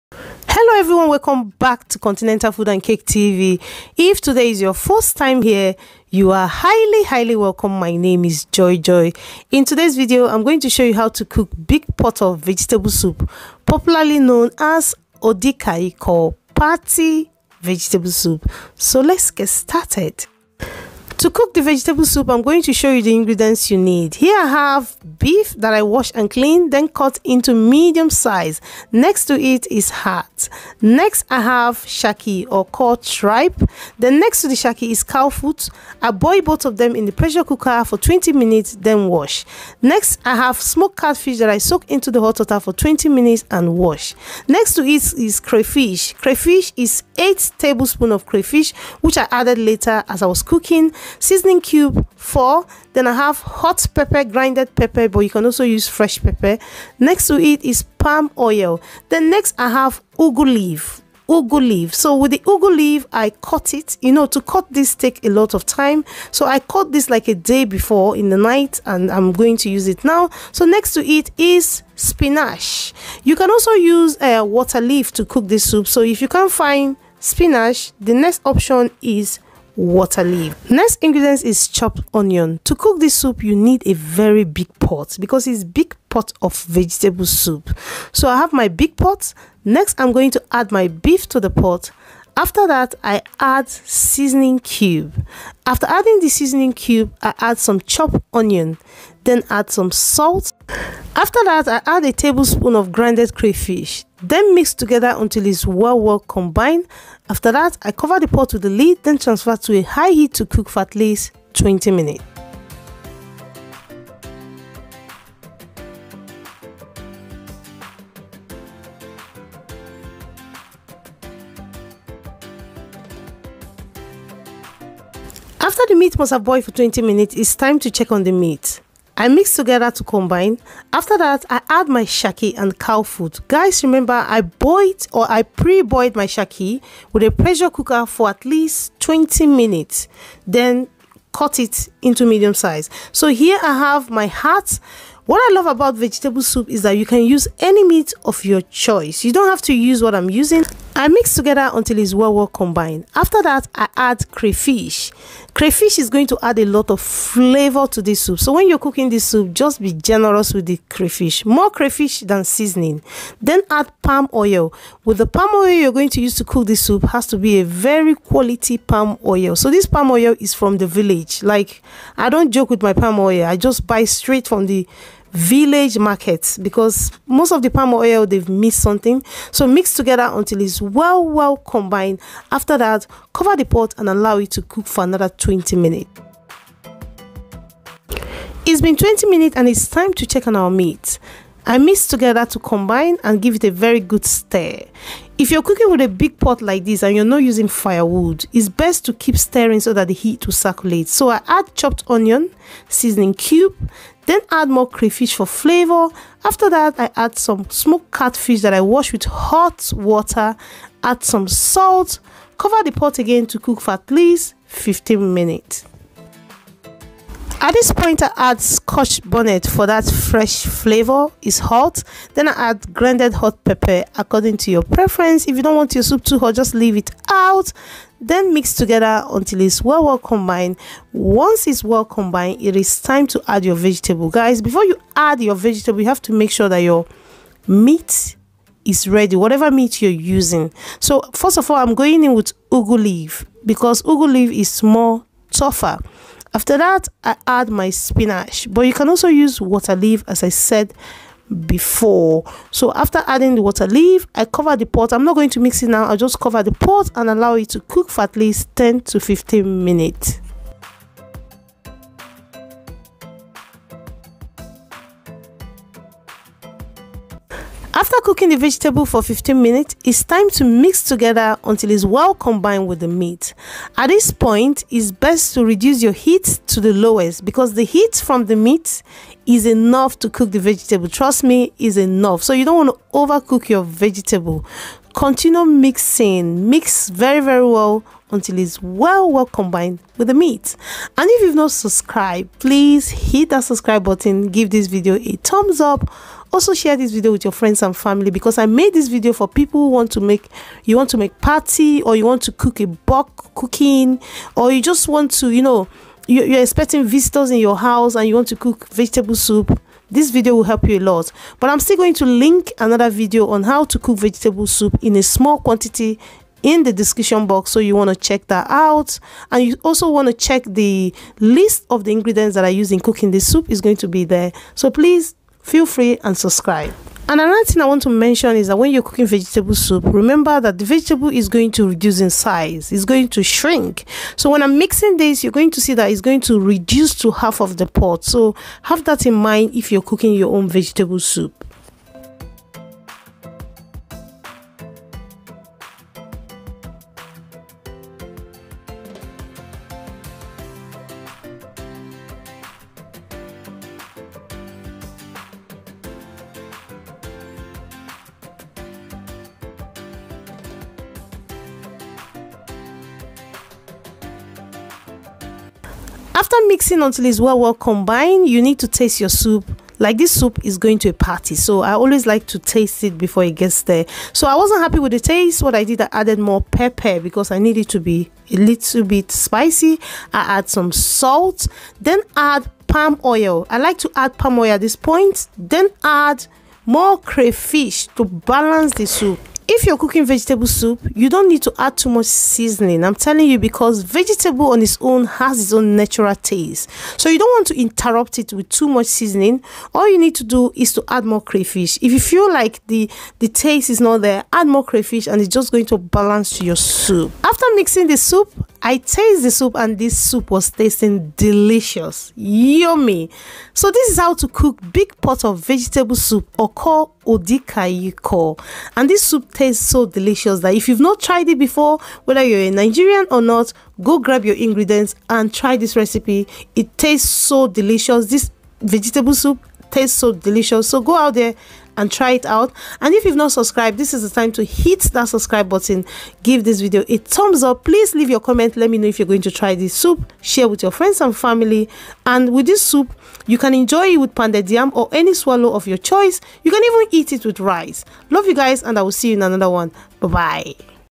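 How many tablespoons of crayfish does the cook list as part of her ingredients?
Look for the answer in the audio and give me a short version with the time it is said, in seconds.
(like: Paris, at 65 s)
8, at 47 s.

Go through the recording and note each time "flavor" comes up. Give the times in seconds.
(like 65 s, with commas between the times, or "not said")
156 s, 205 s, 220 s.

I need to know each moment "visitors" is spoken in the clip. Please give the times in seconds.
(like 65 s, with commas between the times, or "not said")
307 s.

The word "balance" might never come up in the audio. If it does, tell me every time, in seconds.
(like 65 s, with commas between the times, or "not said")
388 s, 405 s.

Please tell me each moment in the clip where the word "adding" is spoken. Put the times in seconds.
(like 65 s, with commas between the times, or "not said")
95 s, 253 s.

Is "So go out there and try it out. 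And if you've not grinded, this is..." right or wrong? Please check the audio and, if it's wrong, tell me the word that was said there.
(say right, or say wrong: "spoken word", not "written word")
wrong: "subscribed", not "grinded".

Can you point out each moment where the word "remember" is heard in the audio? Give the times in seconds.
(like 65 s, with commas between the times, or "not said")
133 s, 330 s.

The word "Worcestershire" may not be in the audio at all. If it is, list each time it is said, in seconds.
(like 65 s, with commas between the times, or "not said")
not said.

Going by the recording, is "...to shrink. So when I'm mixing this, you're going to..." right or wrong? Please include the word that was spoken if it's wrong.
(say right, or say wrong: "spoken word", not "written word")
right.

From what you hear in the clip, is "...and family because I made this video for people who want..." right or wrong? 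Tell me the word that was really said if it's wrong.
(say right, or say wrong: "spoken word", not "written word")
right.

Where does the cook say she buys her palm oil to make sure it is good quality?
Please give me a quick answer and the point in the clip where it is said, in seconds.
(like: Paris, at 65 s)
village markets, at 175 s.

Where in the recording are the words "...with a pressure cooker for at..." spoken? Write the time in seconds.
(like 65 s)
137 s.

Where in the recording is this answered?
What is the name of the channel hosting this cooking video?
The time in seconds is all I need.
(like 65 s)
1 s.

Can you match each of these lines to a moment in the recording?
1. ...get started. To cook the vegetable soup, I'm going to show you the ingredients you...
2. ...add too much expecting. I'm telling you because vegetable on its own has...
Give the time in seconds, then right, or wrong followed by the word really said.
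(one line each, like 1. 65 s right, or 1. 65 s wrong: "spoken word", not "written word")
1. 19 s right
2. 391 s wrong: "seasoning", not "expecting".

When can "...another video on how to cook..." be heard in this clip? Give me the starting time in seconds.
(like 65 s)
312 s.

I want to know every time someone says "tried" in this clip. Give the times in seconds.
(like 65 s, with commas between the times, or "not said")
421 s.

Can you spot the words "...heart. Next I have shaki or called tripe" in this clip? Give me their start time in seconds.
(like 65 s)
29 s.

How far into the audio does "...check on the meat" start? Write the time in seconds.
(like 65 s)
127 s.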